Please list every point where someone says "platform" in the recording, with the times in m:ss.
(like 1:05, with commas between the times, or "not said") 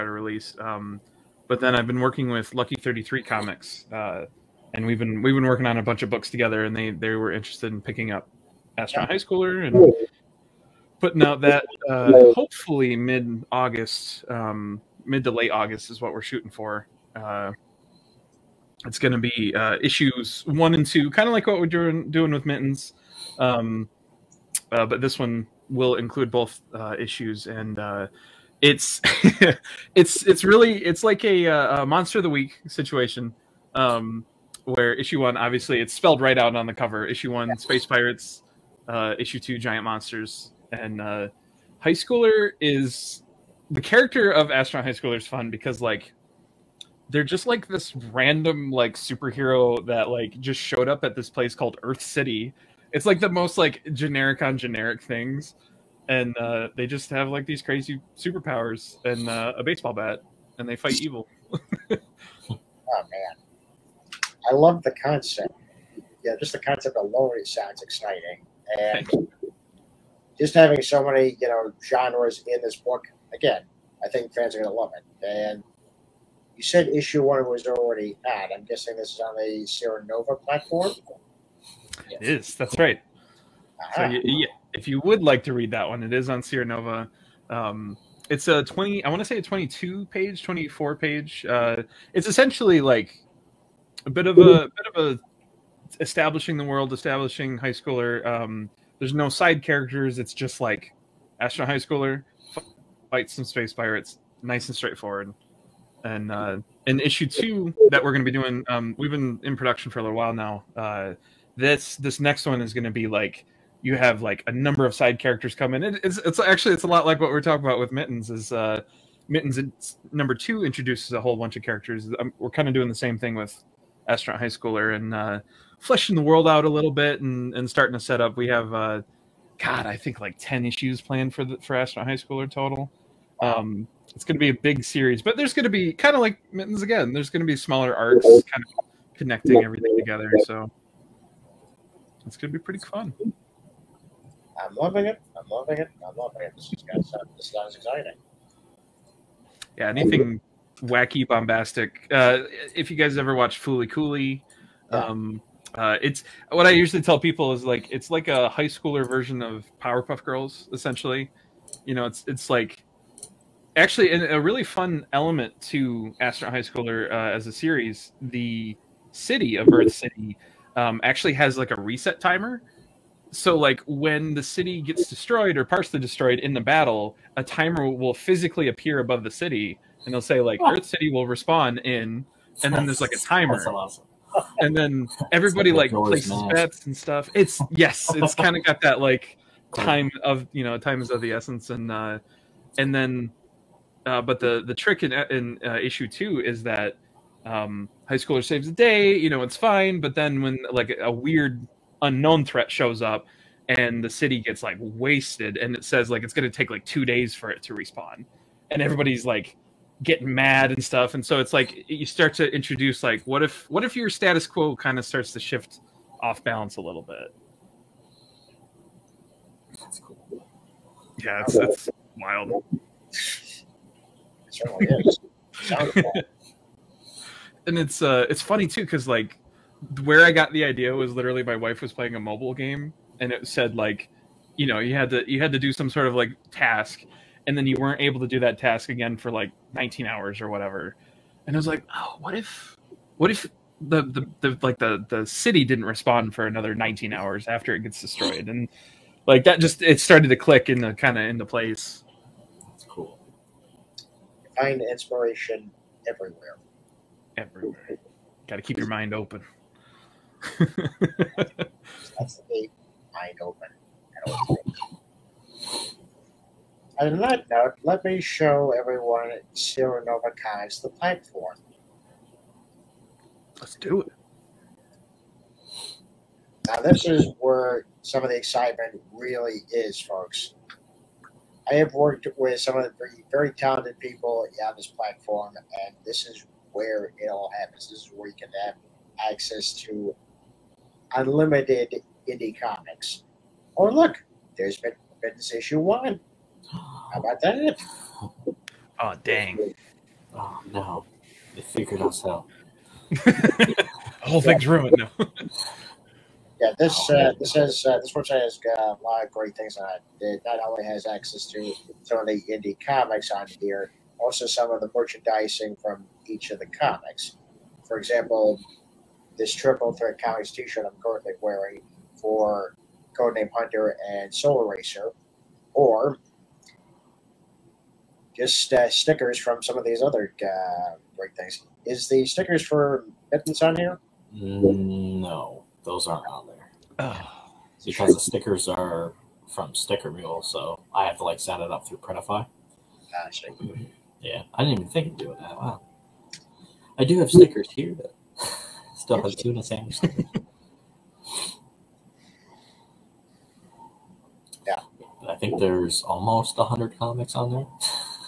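1:20, 4:30, 4:44.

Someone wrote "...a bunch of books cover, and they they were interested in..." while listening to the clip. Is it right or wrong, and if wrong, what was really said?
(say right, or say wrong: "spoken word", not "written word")
wrong: "together", not "cover".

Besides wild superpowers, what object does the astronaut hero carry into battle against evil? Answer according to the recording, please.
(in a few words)
a baseball bat.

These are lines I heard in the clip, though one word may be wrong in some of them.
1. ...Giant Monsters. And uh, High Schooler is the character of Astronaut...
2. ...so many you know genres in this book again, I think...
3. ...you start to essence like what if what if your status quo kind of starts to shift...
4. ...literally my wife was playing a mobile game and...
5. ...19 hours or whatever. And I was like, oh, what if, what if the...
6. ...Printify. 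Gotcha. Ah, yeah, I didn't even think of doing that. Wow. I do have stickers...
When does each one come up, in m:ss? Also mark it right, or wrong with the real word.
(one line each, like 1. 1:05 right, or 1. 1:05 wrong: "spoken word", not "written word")
1. 0:39 right
2. 1:10 right
3. 3:31 wrong: "introduce", not "essence"
4. 3:51 right
5. 3:59 right
6. 5:41 right.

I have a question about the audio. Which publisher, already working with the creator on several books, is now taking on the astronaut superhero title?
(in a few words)
Lucky Thirty Three Comics.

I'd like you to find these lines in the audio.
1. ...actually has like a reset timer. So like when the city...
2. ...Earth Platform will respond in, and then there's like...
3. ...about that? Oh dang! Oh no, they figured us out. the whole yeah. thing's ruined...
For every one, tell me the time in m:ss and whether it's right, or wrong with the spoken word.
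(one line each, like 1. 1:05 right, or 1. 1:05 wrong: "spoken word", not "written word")
1. 2:51 right
2. 3:00 wrong: "City", not "Platform"
3. 4:57 right.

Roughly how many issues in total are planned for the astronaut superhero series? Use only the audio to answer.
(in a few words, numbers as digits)
10.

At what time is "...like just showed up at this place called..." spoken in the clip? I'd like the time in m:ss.
0:50.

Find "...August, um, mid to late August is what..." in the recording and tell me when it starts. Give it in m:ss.
0:13.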